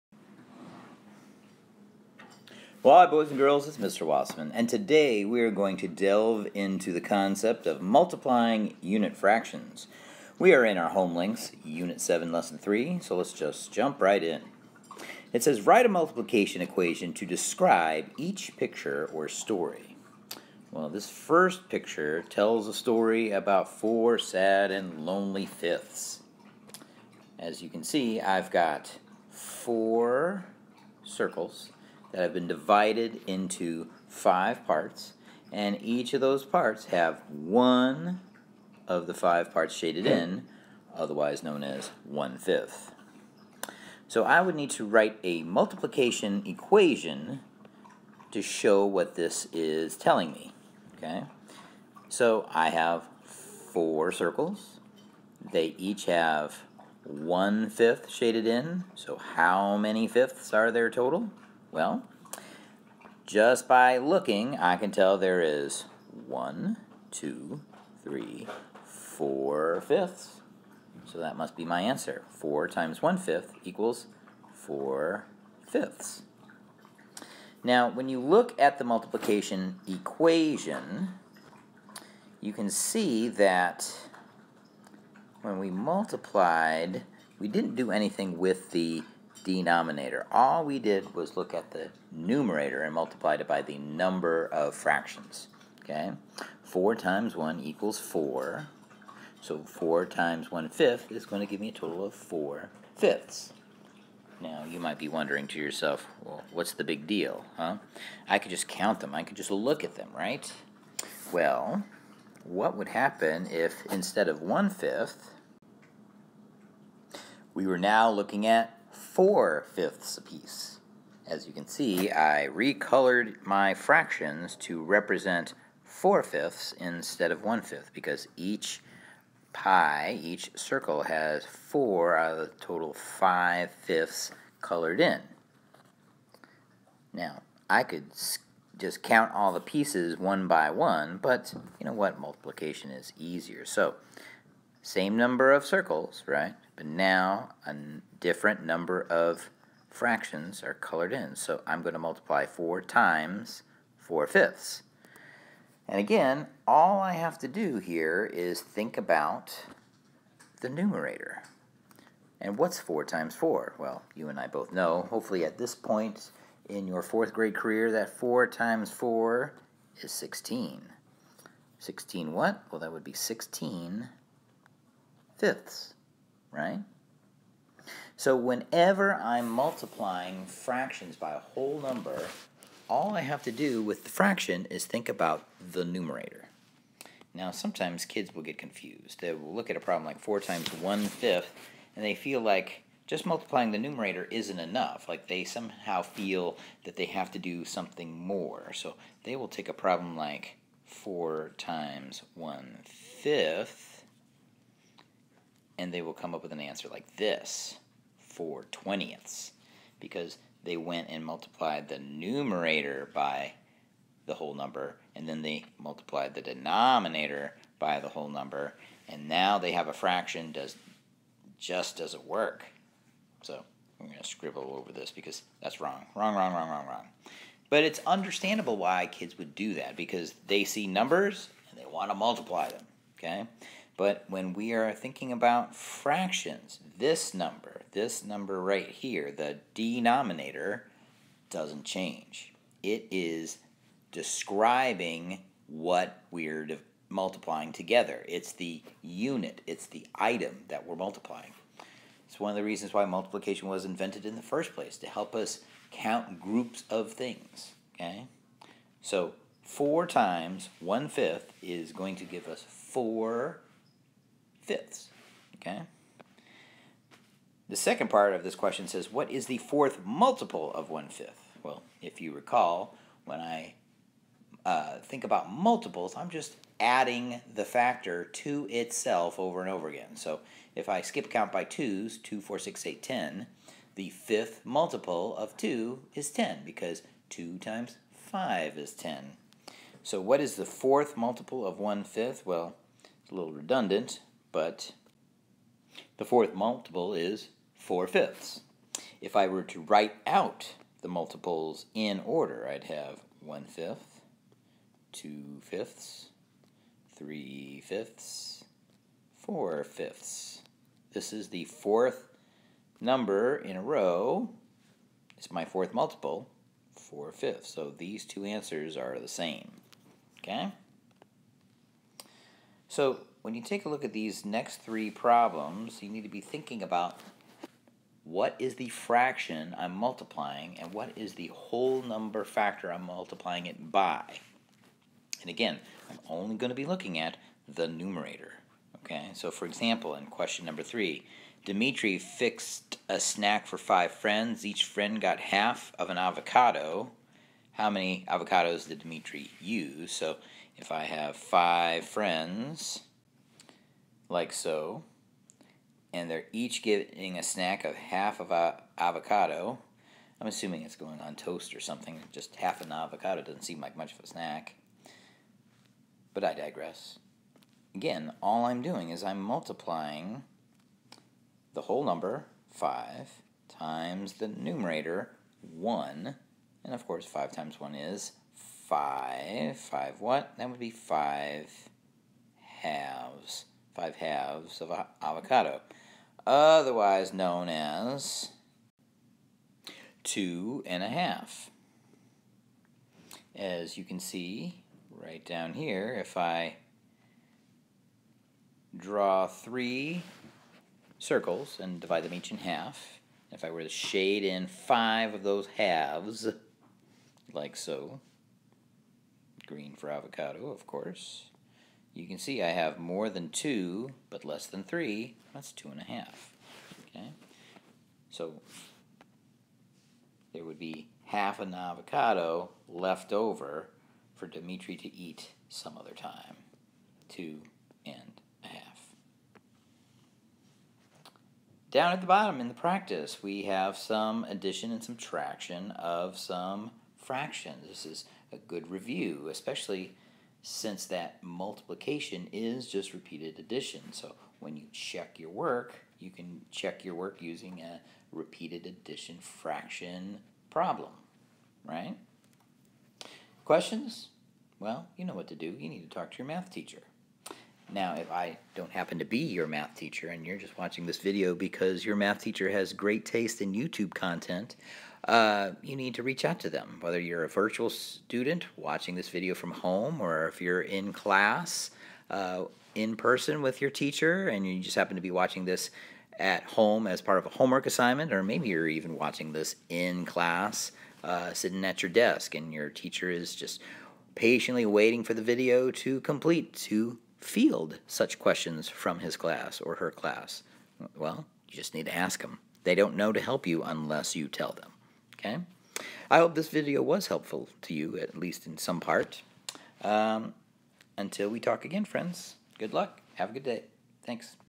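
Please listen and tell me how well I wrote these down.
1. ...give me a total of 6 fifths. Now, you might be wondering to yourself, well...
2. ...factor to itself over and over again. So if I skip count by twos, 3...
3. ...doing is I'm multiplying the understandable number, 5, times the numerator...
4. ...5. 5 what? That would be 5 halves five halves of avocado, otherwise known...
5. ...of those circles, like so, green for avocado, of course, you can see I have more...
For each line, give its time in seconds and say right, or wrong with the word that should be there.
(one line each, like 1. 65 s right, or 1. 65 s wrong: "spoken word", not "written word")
1. 101 s wrong: "4", not "6"
2. 277 s wrong: "2", not "3"
3. 368 s wrong: "whole", not "understandable"
4. 378 s right
5. 405 s wrong: "halves", not "circles".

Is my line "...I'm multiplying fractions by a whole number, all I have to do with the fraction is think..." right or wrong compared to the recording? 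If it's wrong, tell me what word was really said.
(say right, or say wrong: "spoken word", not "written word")
right.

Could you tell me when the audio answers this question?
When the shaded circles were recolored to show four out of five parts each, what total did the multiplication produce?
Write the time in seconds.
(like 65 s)
173 s.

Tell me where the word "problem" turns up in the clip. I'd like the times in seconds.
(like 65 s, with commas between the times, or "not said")
189 s, 199 s, 325 s, 450 s.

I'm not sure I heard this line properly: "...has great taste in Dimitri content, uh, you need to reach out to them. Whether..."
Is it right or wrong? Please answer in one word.
wrong.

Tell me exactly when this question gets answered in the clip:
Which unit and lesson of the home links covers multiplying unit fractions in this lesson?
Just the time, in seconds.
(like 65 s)
11 s.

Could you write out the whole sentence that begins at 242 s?
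It is describing what we're multiplying together.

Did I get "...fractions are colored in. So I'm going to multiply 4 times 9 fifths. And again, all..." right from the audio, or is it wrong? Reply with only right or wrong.
wrong.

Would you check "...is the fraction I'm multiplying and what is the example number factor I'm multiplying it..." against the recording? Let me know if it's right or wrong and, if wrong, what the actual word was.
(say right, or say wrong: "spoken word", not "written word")
wrong: "whole", not "example".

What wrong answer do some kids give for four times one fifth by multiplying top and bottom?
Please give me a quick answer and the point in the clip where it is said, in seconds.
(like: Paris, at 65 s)
4 twentieths, at 208 s.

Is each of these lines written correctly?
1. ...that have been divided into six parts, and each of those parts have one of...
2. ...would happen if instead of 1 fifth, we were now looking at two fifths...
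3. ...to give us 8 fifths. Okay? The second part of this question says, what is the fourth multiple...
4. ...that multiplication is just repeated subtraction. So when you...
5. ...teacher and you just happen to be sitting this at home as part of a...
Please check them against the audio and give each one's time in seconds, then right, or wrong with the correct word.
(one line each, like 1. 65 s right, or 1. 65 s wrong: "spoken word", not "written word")
1. 32 s wrong: "five", not "six"
2. 112 s wrong: "four", not "two"
3. 262 s wrong: "4", not "8"
4. 441 s wrong: "addition", not "subtraction"
5. 473 s wrong: "watching", not "sitting".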